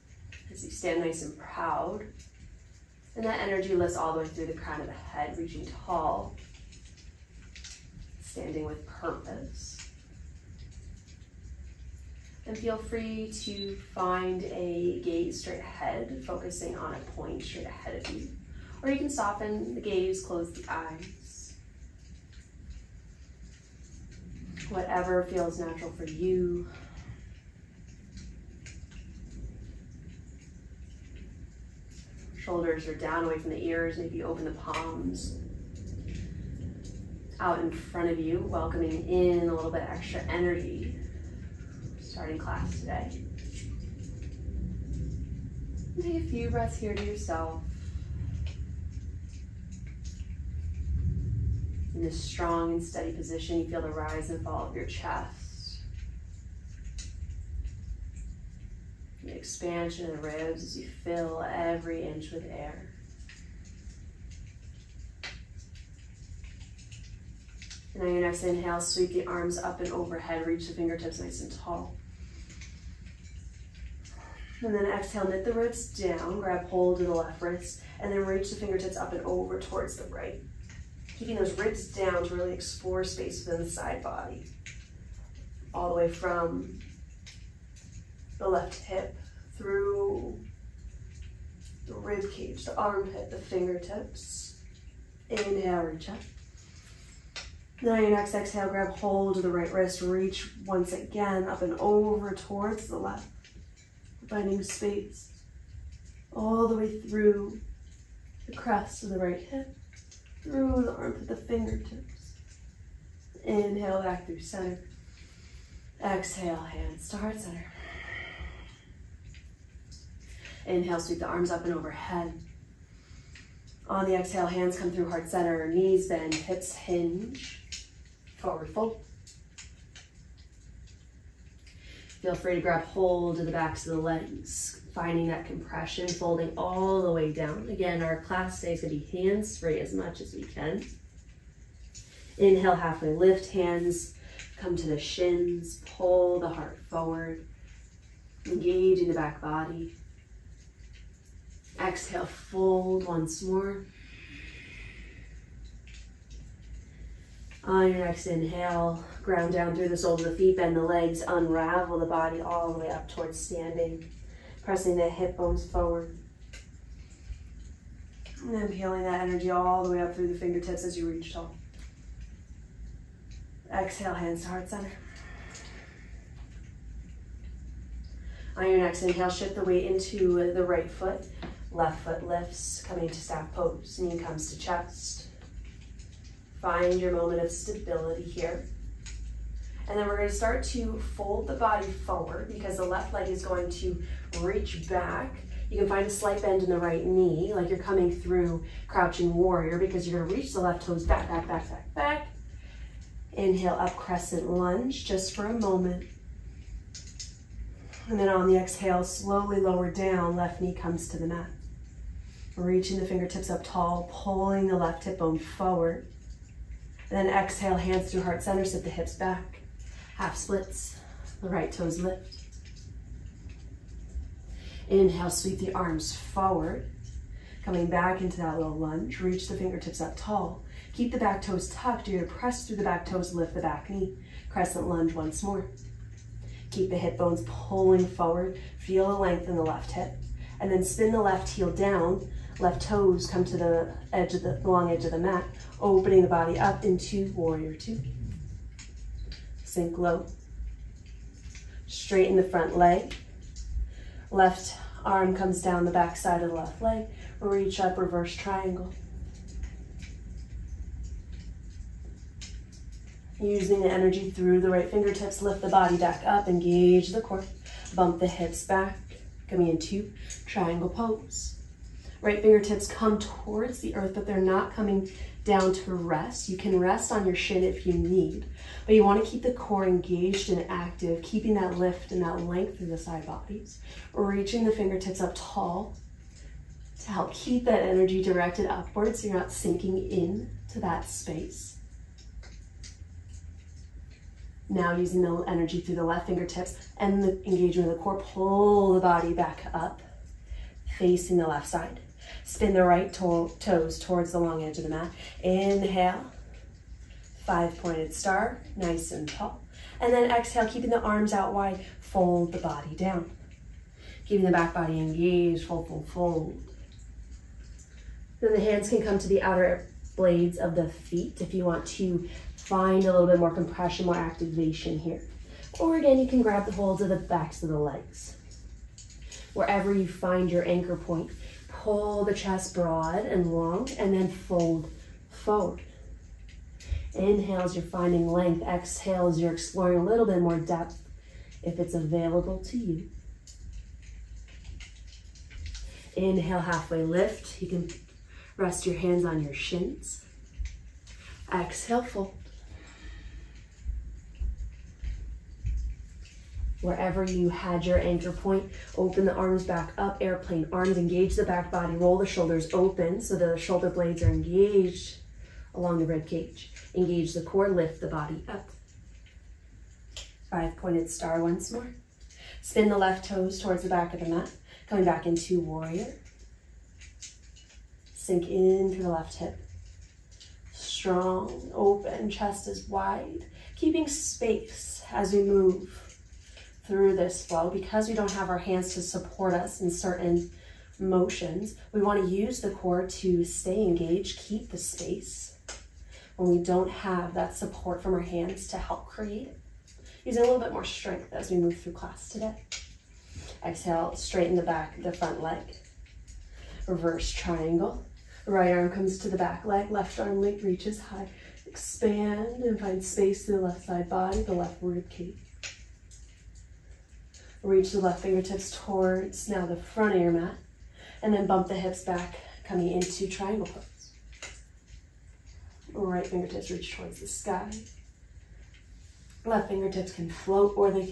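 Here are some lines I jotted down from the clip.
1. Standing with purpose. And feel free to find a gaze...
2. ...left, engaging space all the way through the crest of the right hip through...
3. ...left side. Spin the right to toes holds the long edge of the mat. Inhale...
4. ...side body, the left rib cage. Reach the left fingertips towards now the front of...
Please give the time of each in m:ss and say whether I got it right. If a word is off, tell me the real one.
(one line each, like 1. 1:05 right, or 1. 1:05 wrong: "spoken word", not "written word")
1. 0:08 right
2. 1:42 wrong: "finding", not "engaging"
3. 5:01 wrong: "towards", not "holds"
4. 6:53 right.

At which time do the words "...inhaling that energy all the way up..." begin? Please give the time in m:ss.
2:48.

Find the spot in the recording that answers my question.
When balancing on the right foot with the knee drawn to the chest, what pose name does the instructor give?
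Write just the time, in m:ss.
3:03.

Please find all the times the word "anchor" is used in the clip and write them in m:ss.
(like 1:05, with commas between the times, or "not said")
5:30, 5:57.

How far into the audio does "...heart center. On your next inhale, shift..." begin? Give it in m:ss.
2:54.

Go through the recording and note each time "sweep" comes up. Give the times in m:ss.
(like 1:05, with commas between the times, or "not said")
1:08, 2:01, 3:45.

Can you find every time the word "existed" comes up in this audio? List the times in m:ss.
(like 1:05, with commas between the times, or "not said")
not said.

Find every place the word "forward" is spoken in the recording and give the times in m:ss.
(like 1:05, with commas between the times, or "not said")
2:08, 2:26, 2:45, 3:11, 3:35, 3:46, 3:58, 5:35.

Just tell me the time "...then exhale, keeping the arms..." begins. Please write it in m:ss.
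5:10.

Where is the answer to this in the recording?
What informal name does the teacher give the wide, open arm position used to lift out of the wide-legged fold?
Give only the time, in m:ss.
6:00.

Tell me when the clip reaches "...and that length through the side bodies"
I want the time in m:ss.
4:42.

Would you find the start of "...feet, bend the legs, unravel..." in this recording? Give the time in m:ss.
2:40.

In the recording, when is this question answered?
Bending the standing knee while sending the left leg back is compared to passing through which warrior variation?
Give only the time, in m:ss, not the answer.
3:18.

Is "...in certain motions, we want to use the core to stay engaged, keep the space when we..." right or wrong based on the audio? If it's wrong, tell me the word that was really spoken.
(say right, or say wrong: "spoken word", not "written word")
right.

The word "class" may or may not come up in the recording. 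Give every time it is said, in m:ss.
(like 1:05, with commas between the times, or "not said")
0:42, 2:18, 6:41.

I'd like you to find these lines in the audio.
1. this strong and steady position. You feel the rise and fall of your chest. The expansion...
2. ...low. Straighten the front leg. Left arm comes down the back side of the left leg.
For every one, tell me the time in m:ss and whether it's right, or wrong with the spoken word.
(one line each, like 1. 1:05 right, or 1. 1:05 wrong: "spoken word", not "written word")
1. 0:52 right
2. 4:09 right.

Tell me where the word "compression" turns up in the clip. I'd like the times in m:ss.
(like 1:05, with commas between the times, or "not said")
2:15, 5:23.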